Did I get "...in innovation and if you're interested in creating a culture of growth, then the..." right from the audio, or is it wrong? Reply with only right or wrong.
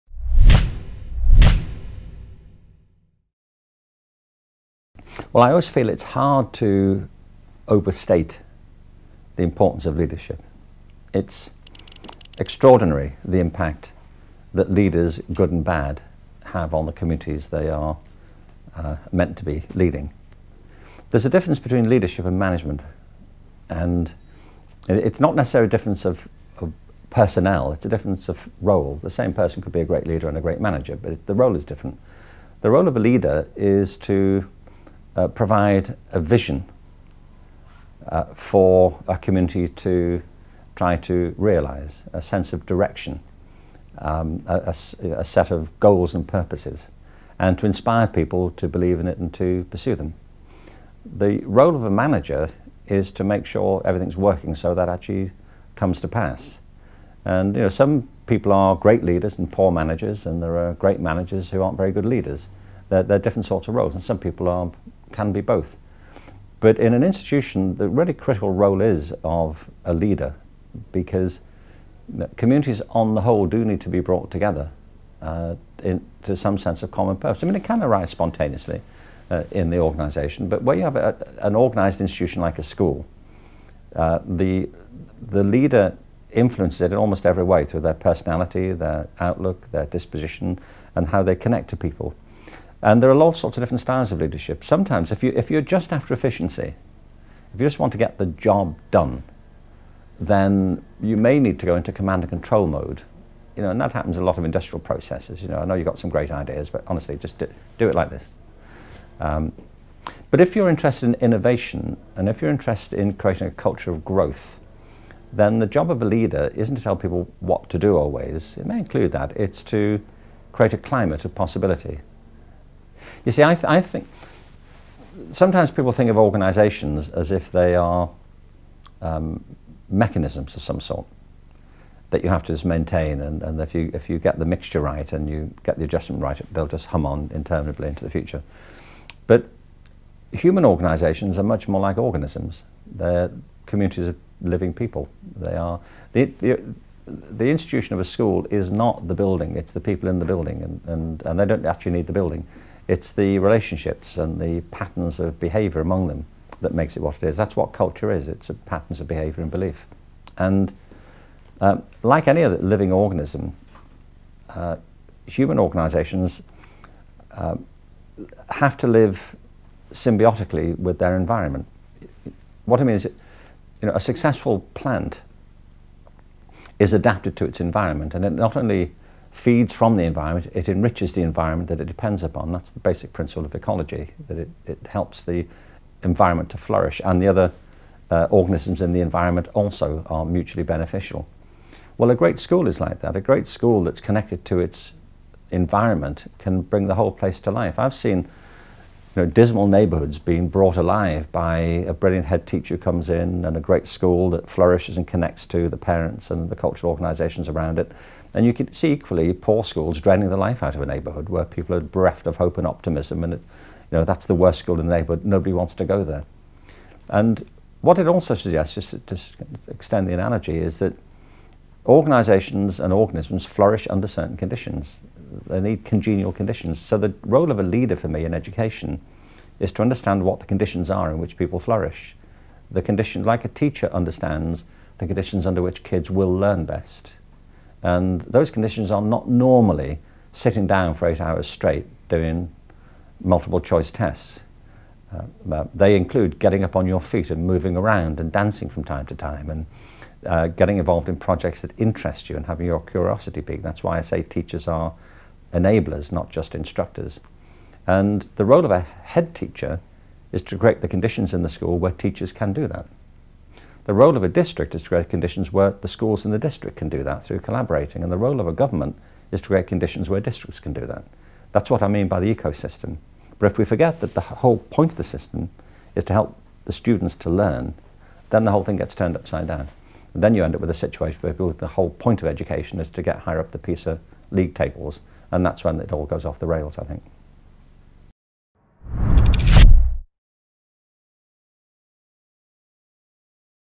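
right.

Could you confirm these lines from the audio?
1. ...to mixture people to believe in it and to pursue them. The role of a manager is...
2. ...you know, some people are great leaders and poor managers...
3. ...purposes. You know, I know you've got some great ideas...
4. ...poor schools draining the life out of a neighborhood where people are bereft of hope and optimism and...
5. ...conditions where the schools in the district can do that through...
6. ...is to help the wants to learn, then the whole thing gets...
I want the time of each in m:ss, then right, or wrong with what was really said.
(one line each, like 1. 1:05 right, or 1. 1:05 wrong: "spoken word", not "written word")
1. 0:47 wrong: "inspire", not "mixture"
2. 0:57 right
3. 1:44 wrong: "processes", not "purposes"
4. 3:29 right
5. 4:25 right
6. 4:35 wrong: "students", not "wants".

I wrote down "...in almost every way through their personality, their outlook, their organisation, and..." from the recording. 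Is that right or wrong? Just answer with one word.
wrong.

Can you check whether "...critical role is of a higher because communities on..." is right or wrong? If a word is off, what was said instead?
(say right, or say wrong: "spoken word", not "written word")
wrong: "leader", not "higher".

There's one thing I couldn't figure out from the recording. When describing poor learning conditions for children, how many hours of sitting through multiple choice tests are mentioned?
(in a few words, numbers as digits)
8.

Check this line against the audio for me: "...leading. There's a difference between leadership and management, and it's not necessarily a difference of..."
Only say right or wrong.
right.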